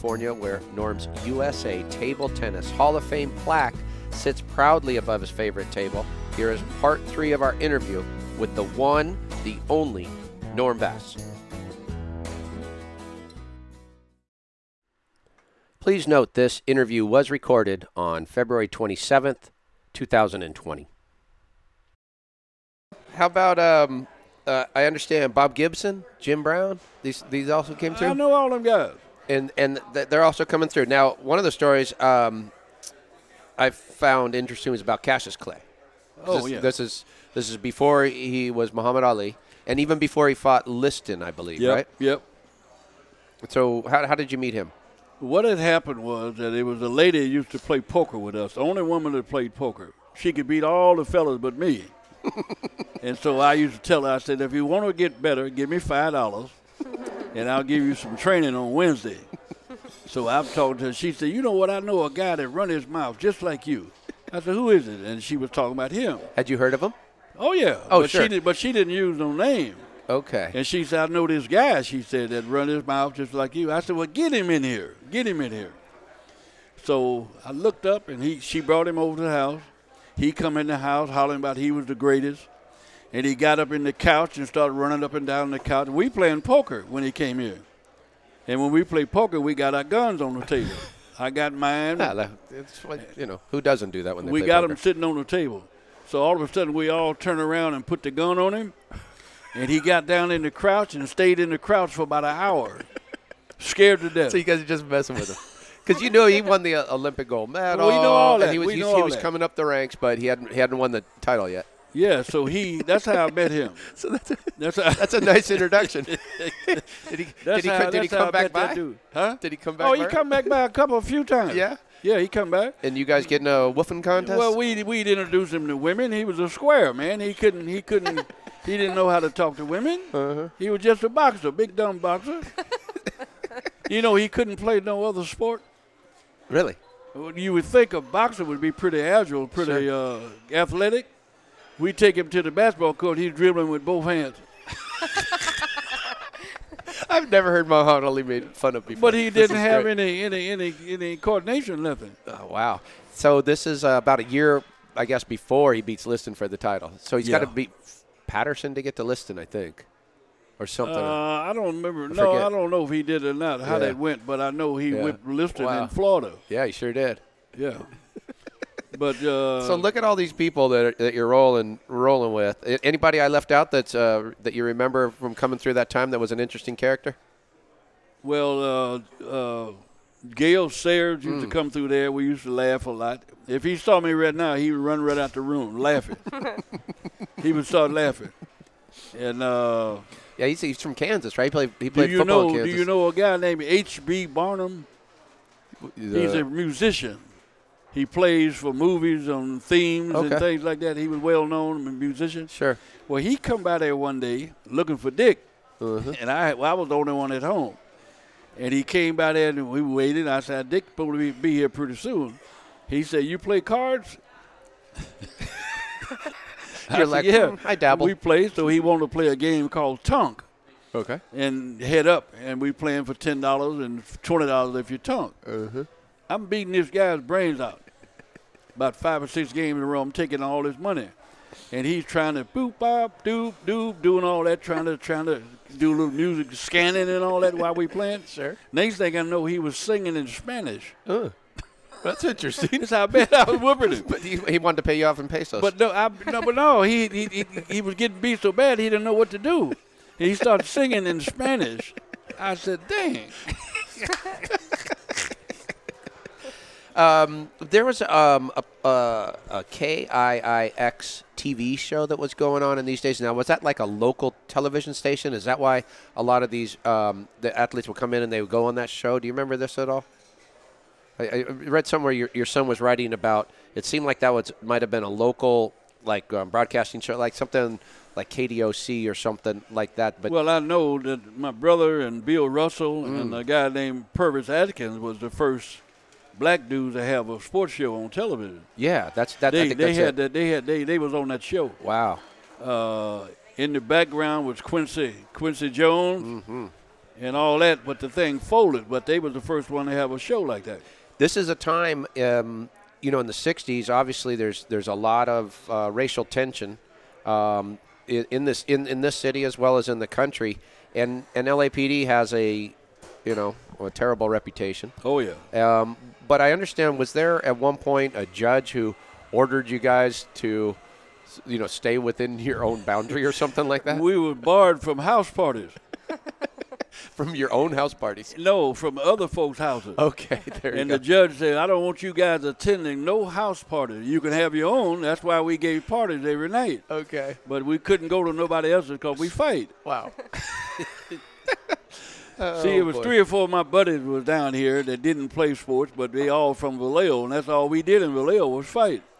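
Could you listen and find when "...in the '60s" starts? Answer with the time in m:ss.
5:03.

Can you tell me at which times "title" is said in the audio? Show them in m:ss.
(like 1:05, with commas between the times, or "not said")
1:51, 2:36.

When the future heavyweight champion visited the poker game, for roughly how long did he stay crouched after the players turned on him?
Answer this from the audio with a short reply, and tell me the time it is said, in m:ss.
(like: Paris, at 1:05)
About an hour, at 1:42.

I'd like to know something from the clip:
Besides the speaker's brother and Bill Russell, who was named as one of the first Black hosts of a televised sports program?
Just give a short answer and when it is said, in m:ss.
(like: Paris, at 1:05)
Purvis Atkins, at 4:44.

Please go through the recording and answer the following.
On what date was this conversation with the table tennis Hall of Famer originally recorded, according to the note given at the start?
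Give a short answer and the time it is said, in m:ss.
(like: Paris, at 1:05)
February 27th, 2020, at 0:18.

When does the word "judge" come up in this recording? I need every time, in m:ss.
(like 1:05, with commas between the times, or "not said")
5:18, 5:31.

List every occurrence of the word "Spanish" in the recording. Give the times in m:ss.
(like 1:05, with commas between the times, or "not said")
4:00, 4:11.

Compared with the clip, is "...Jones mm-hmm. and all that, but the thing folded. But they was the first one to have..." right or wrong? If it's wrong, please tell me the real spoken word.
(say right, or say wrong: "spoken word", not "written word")
right.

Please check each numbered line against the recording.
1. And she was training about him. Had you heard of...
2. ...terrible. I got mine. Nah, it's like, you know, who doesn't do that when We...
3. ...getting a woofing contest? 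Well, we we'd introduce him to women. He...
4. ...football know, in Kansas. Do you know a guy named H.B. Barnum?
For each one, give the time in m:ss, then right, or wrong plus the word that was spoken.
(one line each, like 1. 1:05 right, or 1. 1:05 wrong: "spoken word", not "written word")
1. 1:05 wrong: "talking", not "training"
2. 1:30 wrong: "table", not "terrible"
3. 2:03 right
4. 3:12 right.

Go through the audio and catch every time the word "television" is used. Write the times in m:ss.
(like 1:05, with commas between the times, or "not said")
4:24, 4:48.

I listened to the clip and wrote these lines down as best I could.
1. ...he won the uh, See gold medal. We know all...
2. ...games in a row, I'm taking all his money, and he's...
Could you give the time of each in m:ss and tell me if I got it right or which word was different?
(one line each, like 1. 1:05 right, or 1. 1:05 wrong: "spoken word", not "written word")
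1. 1:46 wrong: "Olympic", not "See"
2. 3:49 right.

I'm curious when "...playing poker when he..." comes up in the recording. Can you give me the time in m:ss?
1:26.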